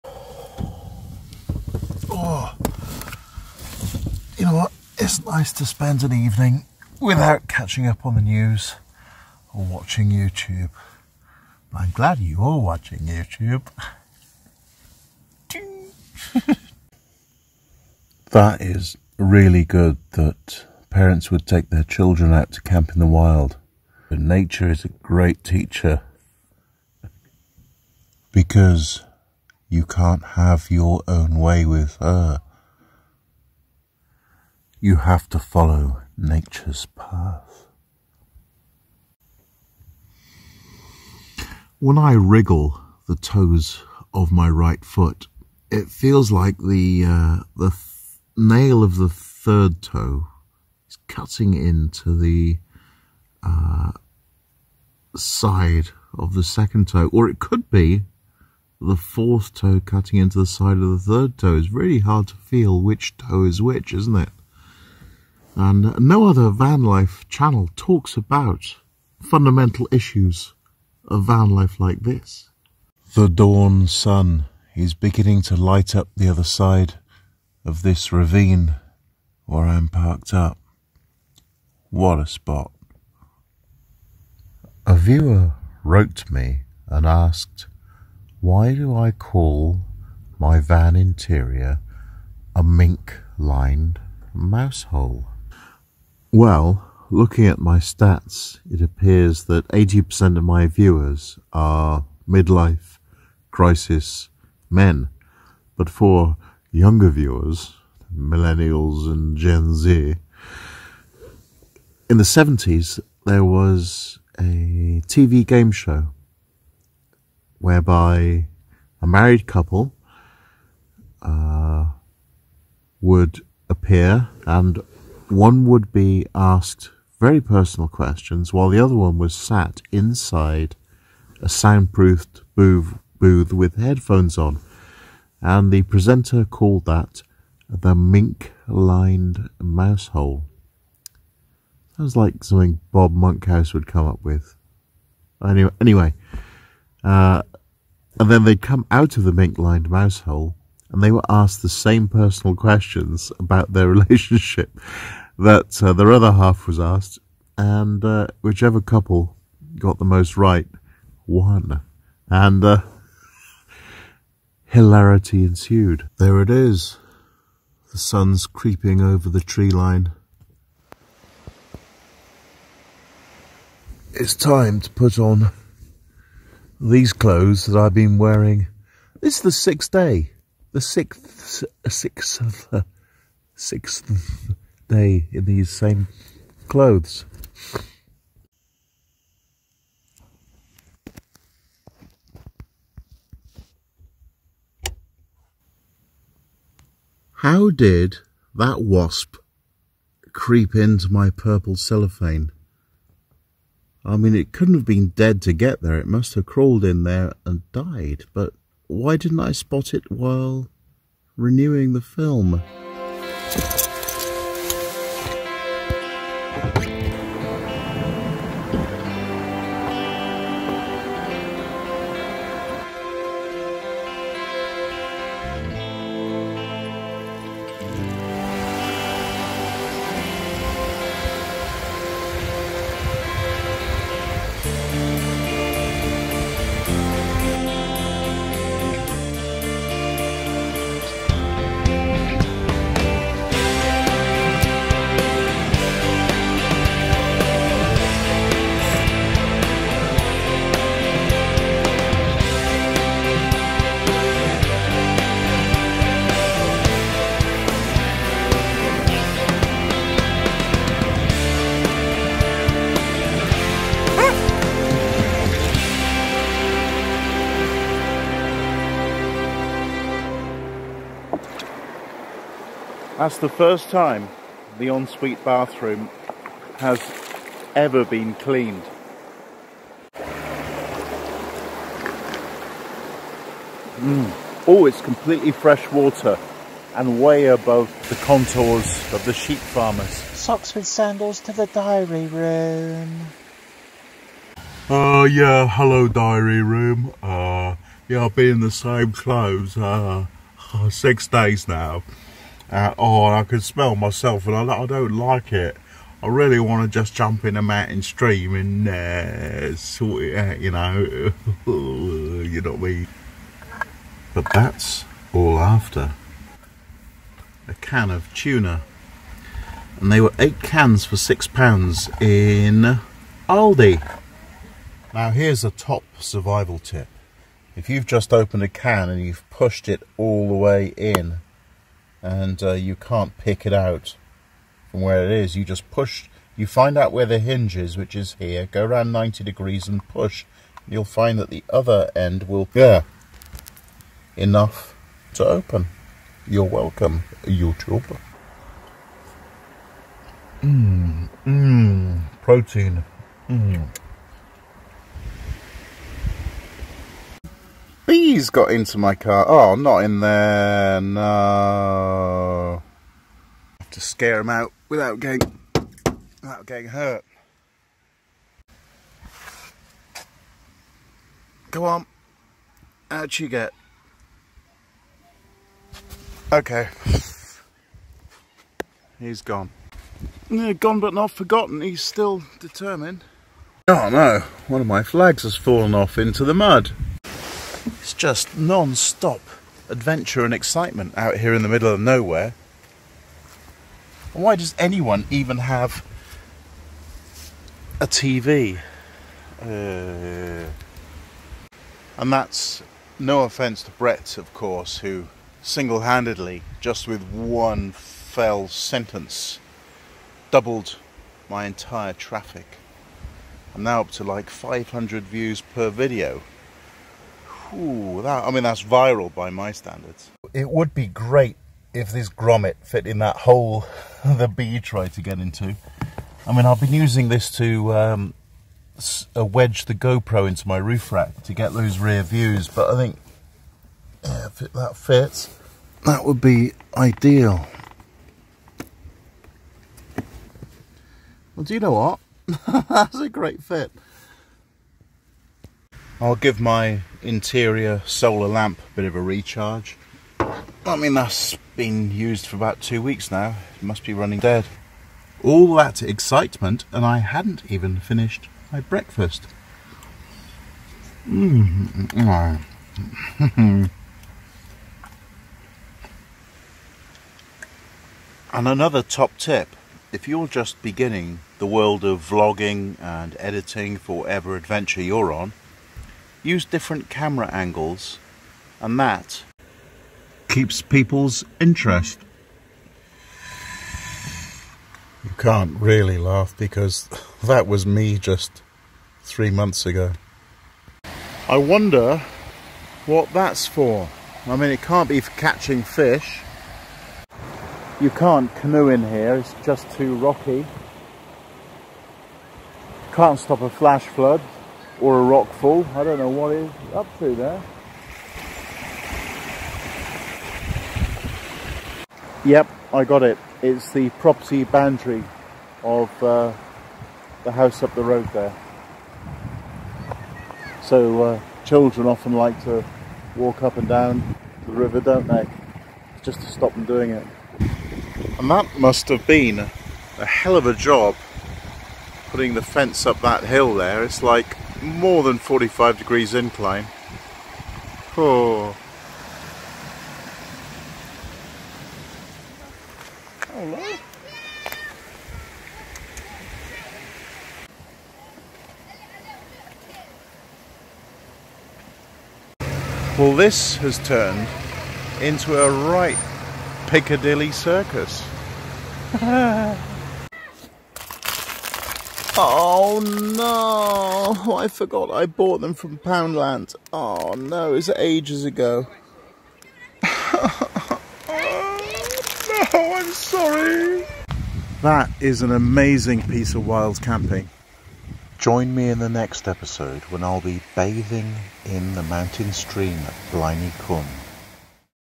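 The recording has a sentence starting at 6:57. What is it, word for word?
Ooh, that, I mean, that's viral by my standards.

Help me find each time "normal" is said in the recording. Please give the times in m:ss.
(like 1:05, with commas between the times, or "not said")
not said.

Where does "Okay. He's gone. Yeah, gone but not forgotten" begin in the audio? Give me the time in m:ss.
6:16.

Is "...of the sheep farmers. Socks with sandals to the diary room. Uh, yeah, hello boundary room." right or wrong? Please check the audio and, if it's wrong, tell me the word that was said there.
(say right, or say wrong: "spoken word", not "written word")
wrong: "diary", not "boundary".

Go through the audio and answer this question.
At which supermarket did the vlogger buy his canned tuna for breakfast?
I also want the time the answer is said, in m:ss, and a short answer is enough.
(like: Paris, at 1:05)
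Aldi, at 5:23.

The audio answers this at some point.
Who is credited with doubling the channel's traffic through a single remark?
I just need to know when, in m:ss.
6:43.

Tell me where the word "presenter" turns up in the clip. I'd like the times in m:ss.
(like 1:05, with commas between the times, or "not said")
2:15.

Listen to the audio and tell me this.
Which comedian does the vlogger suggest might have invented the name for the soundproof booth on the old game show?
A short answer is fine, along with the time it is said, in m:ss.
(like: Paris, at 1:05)
Bob Monkhouse, at 2:22.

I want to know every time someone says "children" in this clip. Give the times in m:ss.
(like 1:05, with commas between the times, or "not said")
0:21, 8:41.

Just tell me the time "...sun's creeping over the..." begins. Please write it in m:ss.
2:47.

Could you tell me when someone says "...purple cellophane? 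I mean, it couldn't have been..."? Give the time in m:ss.
3:21.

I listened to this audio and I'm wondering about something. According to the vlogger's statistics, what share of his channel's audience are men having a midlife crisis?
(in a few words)
80%.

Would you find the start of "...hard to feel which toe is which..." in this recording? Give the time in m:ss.
1:01.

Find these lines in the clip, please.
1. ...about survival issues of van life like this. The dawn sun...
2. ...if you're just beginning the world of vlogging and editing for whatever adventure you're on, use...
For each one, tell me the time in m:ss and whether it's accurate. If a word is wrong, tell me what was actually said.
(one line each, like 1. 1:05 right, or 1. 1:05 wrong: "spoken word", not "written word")
1. 1:08 wrong: "fundamental", not "survival"
2. 7:50 right.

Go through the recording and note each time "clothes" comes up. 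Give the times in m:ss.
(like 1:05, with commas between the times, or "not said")
2:57, 3:06, 4:59.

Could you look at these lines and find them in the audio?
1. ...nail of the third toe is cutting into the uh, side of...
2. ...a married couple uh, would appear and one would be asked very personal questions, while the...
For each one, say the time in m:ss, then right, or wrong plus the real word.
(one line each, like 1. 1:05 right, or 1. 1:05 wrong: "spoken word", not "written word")
1. 0:48 right
2. 1:59 right.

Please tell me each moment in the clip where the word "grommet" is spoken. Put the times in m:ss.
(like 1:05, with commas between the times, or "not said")
7:02.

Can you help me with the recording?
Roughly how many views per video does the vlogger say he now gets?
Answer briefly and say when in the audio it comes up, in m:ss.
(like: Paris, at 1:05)
500, at 6:54.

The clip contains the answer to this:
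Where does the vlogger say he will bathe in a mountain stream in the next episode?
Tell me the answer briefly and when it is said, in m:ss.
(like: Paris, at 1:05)
Bliny Cum, at 9:43.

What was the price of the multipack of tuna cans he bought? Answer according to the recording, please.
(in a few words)
6 pounds.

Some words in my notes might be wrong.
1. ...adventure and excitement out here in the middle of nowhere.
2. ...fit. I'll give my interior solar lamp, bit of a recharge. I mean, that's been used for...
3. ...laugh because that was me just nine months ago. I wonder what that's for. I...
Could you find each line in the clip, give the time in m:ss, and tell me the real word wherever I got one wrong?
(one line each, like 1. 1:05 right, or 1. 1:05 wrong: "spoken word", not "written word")
1. 6:29 right
2. 7:23 right
3. 8:06 wrong: "three", not "nine".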